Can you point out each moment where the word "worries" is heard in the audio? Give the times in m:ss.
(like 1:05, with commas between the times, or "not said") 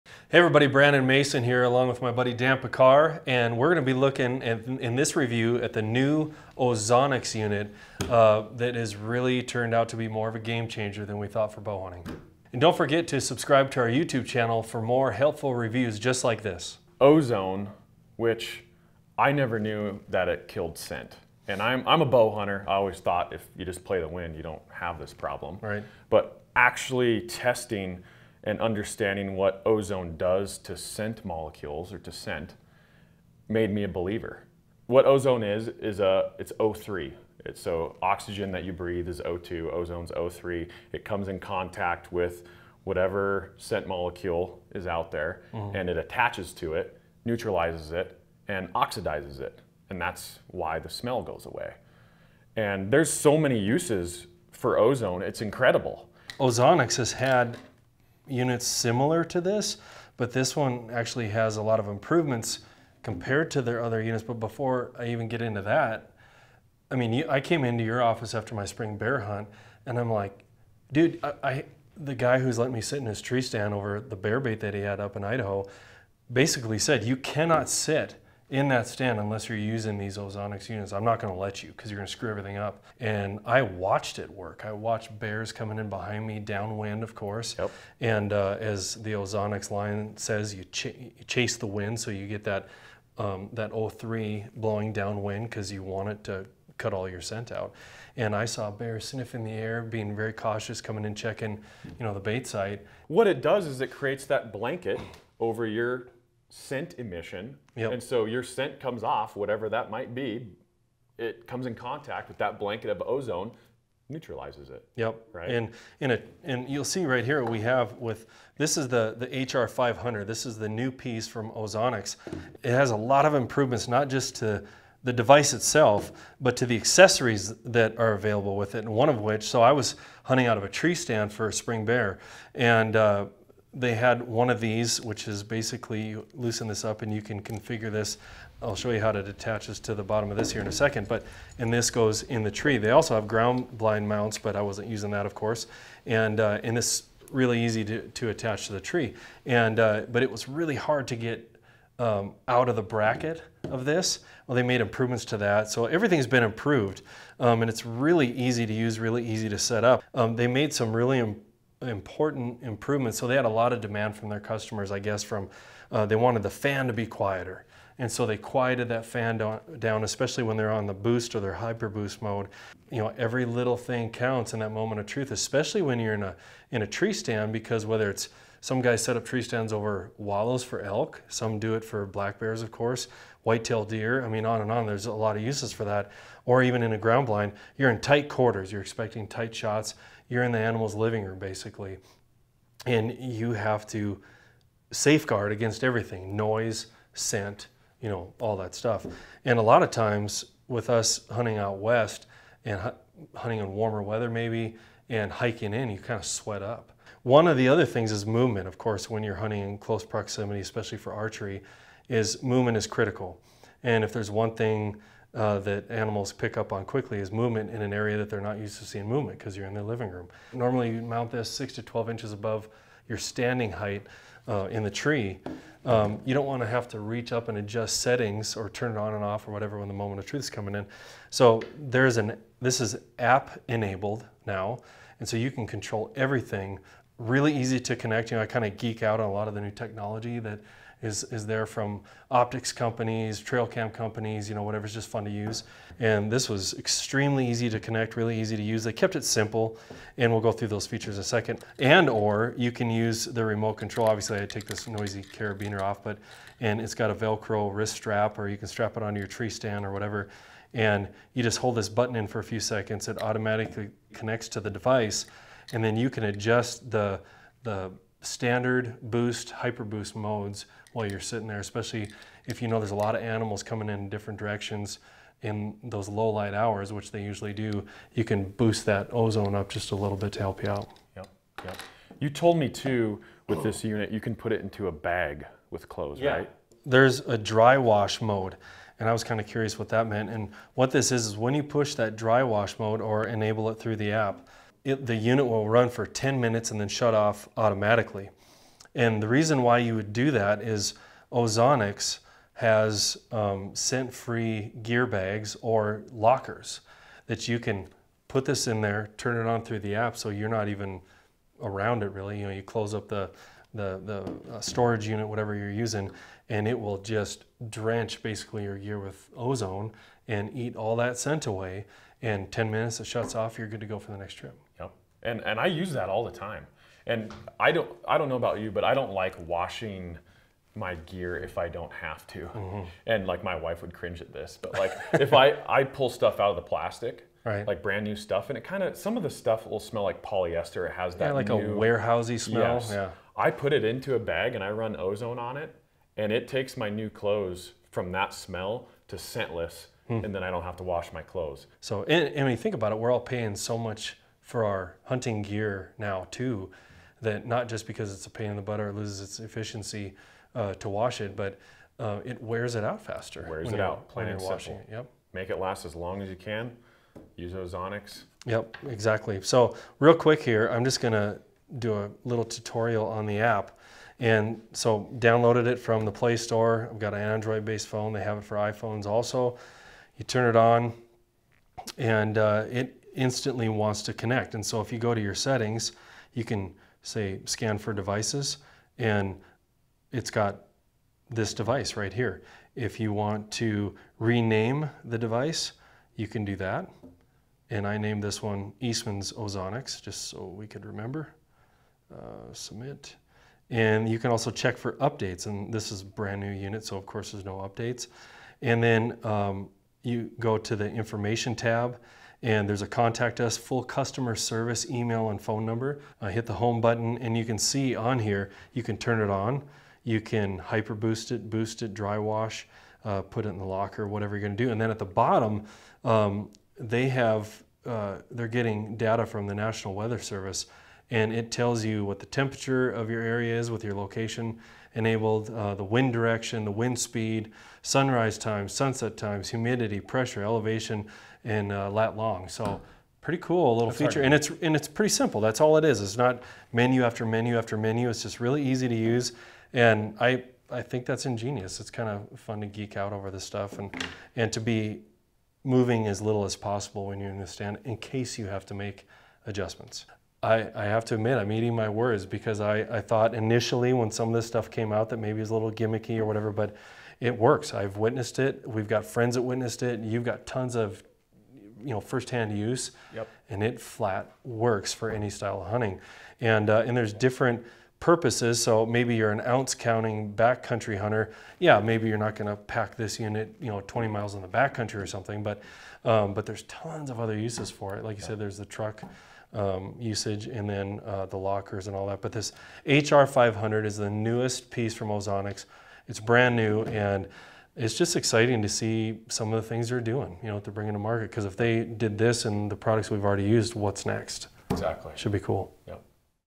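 not said.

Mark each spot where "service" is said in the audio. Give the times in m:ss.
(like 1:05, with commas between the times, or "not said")
6:54, 7:10.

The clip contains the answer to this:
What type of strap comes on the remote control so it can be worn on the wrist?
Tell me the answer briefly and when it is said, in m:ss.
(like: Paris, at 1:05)
Velcro, at 4:17.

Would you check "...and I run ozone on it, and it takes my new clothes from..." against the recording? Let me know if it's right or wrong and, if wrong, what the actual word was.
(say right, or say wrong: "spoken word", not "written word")
right.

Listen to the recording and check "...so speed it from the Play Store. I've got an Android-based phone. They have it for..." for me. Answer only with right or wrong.
wrong.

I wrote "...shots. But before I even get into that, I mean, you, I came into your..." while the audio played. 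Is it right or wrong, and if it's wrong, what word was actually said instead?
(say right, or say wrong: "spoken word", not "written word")
wrong: "units", not "shots".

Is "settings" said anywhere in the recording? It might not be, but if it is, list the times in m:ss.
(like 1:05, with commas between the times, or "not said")
3:48, 6:25.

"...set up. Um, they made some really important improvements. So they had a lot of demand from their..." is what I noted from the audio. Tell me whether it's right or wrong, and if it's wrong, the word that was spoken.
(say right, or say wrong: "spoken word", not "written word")
right.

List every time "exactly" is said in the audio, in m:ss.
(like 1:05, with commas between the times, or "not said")
6:08, 8:24.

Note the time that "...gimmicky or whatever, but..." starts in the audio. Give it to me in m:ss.
7:45.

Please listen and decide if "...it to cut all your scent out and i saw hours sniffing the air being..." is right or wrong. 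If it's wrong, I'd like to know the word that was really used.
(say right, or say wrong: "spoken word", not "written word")
wrong: "bears", not "hours".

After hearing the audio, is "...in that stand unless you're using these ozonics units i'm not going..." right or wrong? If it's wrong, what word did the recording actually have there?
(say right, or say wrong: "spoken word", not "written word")
right.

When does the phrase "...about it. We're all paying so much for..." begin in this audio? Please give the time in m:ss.
5:52.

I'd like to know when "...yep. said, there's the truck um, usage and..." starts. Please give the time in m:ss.
8:08.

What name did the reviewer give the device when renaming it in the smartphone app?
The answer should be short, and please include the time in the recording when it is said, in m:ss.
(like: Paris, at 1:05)
Eastman's Ozonics, at 6:38.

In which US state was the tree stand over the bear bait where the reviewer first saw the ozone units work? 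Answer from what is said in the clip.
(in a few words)
Idaho.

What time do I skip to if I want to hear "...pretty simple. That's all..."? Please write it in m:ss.
7:24.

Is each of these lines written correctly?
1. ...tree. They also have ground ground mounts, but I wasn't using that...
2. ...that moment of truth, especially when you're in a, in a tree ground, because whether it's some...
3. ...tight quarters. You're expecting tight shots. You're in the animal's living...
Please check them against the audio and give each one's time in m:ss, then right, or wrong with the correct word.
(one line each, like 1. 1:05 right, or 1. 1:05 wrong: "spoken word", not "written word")
1. 2:22 wrong: "blind", not "ground"
2. 2:54 wrong: "stand", not "ground"
3. 3:07 right.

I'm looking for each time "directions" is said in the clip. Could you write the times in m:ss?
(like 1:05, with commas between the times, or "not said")
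4:34, 7:16.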